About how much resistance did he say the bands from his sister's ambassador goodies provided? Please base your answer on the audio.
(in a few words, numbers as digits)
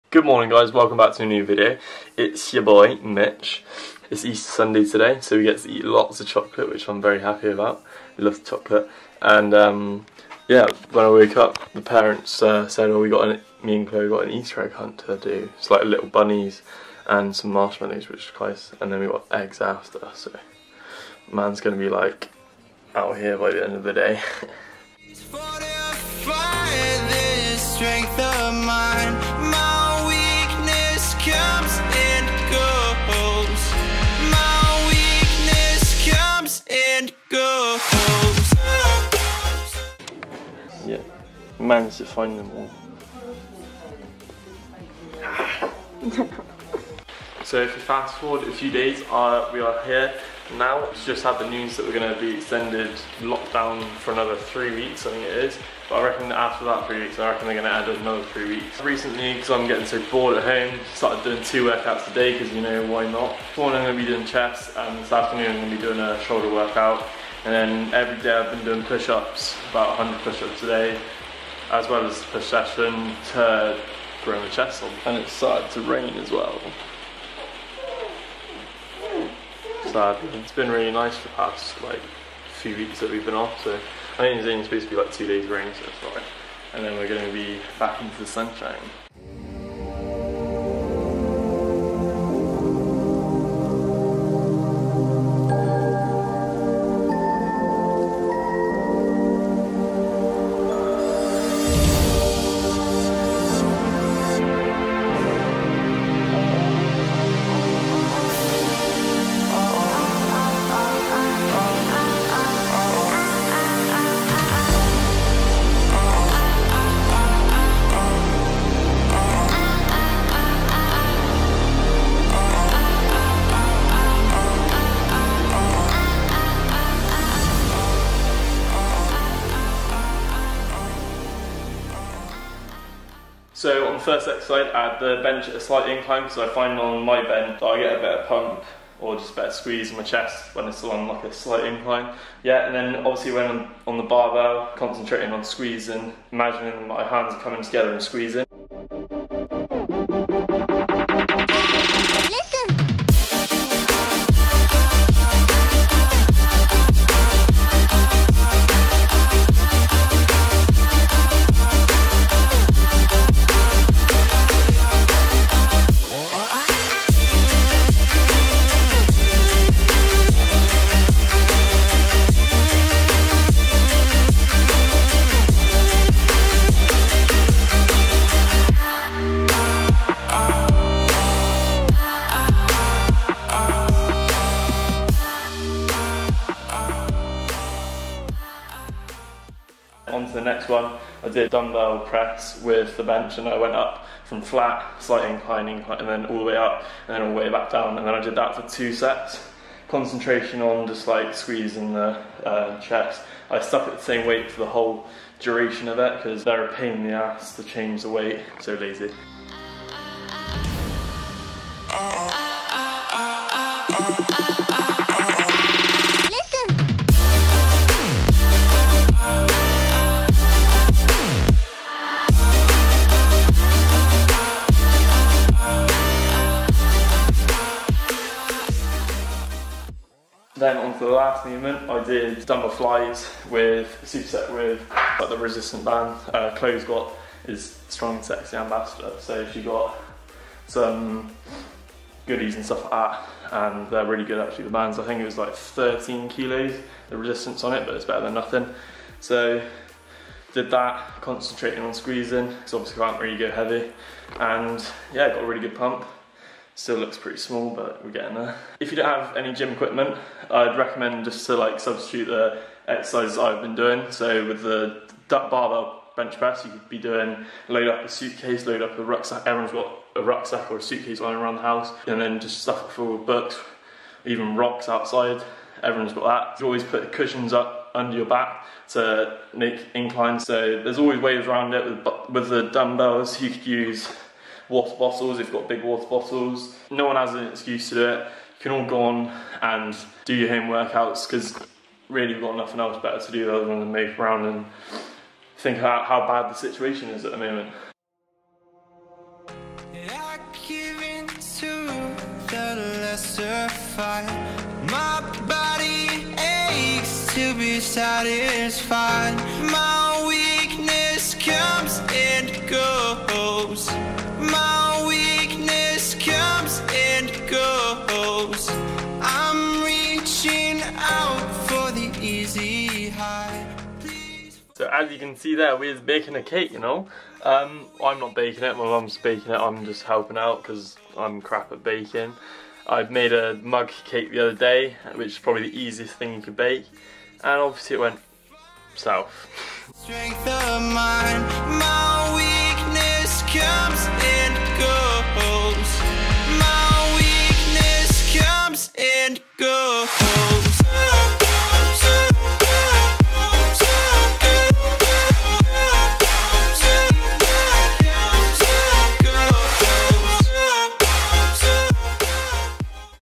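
13 kilos.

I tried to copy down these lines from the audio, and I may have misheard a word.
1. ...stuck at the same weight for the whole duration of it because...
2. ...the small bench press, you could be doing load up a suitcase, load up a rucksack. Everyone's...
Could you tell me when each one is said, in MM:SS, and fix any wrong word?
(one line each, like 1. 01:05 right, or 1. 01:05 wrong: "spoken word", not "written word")
1. 03:23 right
2. 04:24 wrong: "barbell", not "small".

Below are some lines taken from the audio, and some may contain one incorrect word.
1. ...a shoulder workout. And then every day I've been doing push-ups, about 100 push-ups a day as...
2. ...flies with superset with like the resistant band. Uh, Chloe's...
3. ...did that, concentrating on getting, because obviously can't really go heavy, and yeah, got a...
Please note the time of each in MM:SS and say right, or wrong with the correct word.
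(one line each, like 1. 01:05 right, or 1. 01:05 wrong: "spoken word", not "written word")
1. 01:06 right
2. 03:52 right
3. 04:10 wrong: "squeezing", not "getting".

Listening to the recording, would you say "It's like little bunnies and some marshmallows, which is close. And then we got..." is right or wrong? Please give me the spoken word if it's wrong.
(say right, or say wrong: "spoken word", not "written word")
right.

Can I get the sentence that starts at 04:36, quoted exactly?
You always put cushions up under your back to make incline.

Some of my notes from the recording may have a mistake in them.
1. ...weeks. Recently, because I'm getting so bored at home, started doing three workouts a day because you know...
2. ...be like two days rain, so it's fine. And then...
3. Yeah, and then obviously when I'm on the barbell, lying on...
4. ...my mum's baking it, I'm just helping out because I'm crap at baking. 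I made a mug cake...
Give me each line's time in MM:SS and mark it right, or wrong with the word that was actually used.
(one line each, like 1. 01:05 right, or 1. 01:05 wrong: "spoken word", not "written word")
1. 00:58 wrong: "two", not "three"
2. 01:24 right
3. 02:22 wrong: "concentrating", not "lying"
4. 05:28 right.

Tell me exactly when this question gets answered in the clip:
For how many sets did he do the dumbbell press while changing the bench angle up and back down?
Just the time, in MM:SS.
03:18.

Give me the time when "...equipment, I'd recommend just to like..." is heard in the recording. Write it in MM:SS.
04:19.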